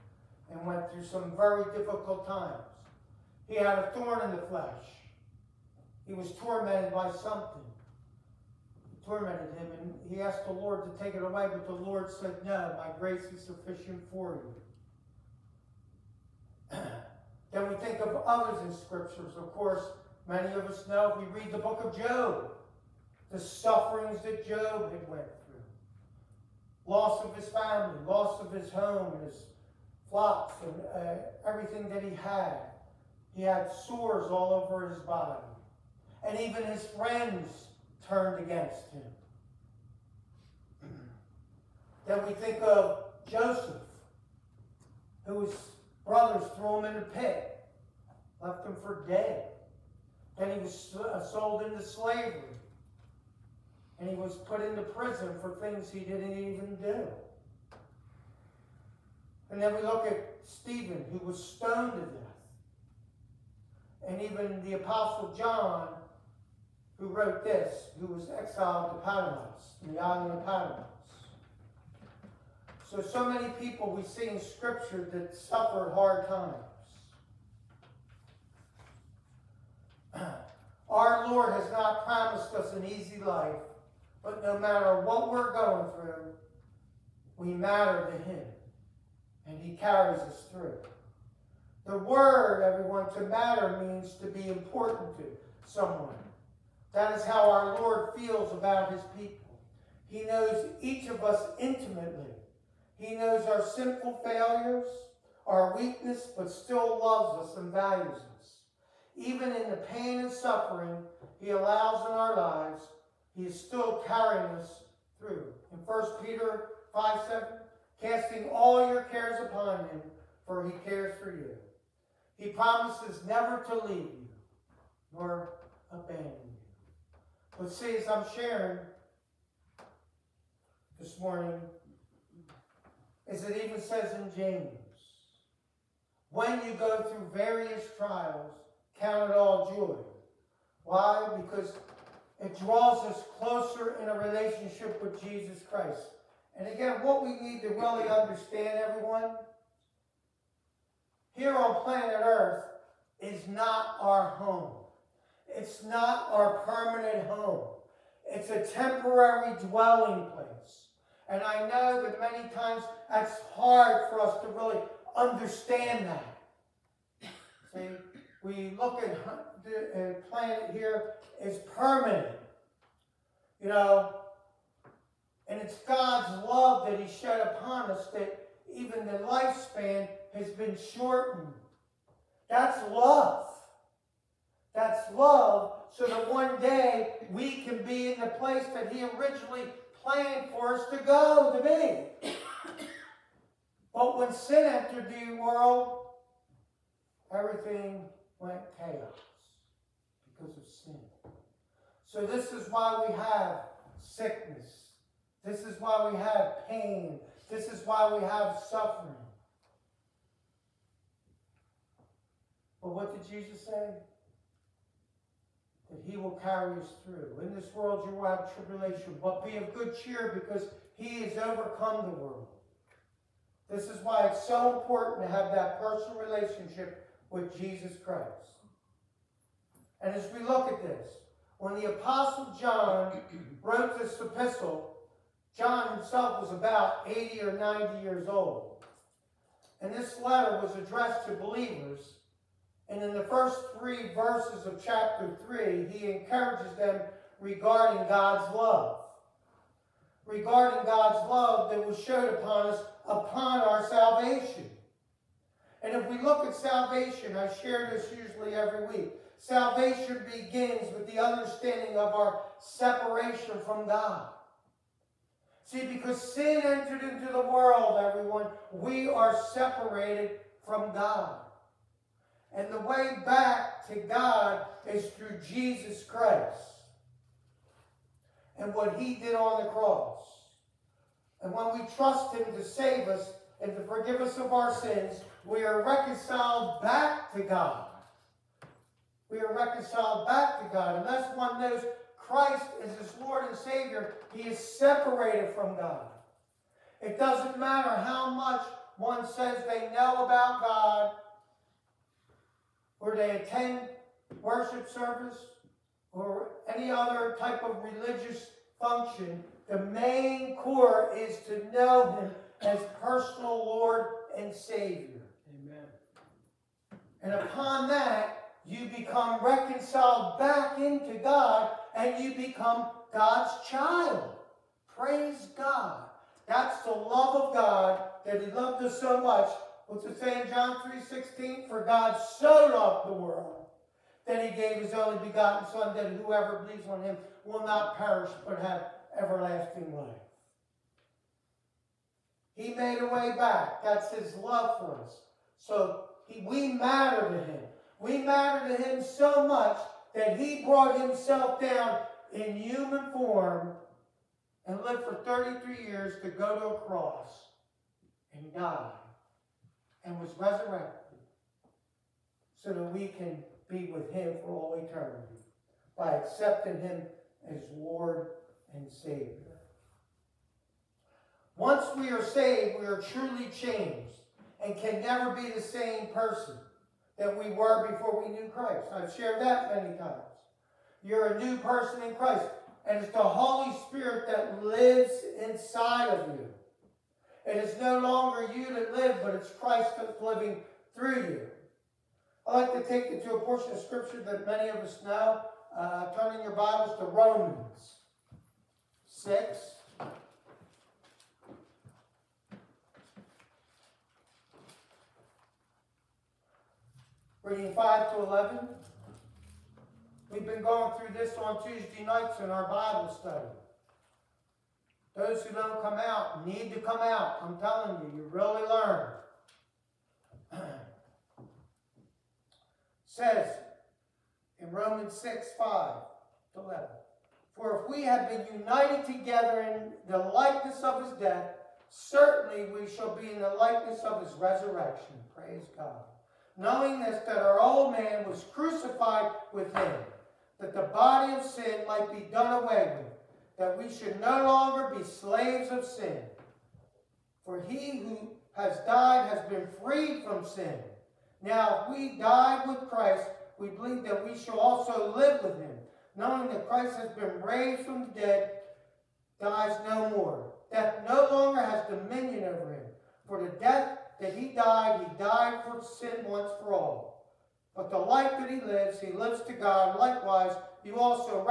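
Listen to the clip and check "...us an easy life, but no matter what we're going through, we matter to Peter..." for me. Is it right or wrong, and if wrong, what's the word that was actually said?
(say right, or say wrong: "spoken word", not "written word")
wrong: "Him", not "Peter".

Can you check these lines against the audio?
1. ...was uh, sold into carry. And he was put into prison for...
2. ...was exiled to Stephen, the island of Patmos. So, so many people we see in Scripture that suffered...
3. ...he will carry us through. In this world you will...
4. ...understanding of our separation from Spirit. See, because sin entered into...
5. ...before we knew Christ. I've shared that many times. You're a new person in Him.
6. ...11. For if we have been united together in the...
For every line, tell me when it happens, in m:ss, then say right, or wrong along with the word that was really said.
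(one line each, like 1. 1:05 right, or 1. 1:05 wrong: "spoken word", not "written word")
1. 0:50 wrong: "slavery", not "carry"
2. 1:08 wrong: "Patmos", not "Stephen"
3. 3:36 right
4. 4:21 wrong: "God", not "Spirit"
5. 6:17 wrong: "Christ", not "Him"
6. 7:06 right.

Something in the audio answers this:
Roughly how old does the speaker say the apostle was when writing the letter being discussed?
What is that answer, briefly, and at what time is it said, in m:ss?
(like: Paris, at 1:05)
80 or 90, at 3:57.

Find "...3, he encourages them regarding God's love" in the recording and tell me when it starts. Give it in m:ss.
4:05.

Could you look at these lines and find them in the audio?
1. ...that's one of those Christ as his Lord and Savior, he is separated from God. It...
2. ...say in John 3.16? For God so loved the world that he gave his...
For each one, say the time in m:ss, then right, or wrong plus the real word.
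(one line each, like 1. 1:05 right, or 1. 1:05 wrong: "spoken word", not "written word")
1. 4:51 right
2. 5:30 right.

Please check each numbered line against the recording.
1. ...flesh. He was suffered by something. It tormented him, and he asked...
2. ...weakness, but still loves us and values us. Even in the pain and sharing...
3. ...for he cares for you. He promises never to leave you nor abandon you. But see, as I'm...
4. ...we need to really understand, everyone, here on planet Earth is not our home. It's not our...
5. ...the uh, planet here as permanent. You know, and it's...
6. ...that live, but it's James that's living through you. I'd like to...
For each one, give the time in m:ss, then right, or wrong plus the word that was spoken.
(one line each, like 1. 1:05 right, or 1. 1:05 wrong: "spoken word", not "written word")
1. 0:04 wrong: "tormented", not "suffered"
2. 1:45 wrong: "suffering", not "sharing"
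3. 2:00 right
4. 2:27 right
5. 2:49 right
6. 6:28 wrong: "Christ", not "James".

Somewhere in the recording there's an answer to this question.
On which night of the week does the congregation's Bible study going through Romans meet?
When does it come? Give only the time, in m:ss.
6:51.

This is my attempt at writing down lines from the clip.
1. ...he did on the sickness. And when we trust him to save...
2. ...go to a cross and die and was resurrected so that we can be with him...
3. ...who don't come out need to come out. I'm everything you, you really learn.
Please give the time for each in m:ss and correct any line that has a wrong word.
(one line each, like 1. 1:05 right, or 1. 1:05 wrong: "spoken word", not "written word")
1. 4:38 wrong: "cross", not "sickness"
2. 5:56 right
3. 6:55 wrong: "telling", not "everything".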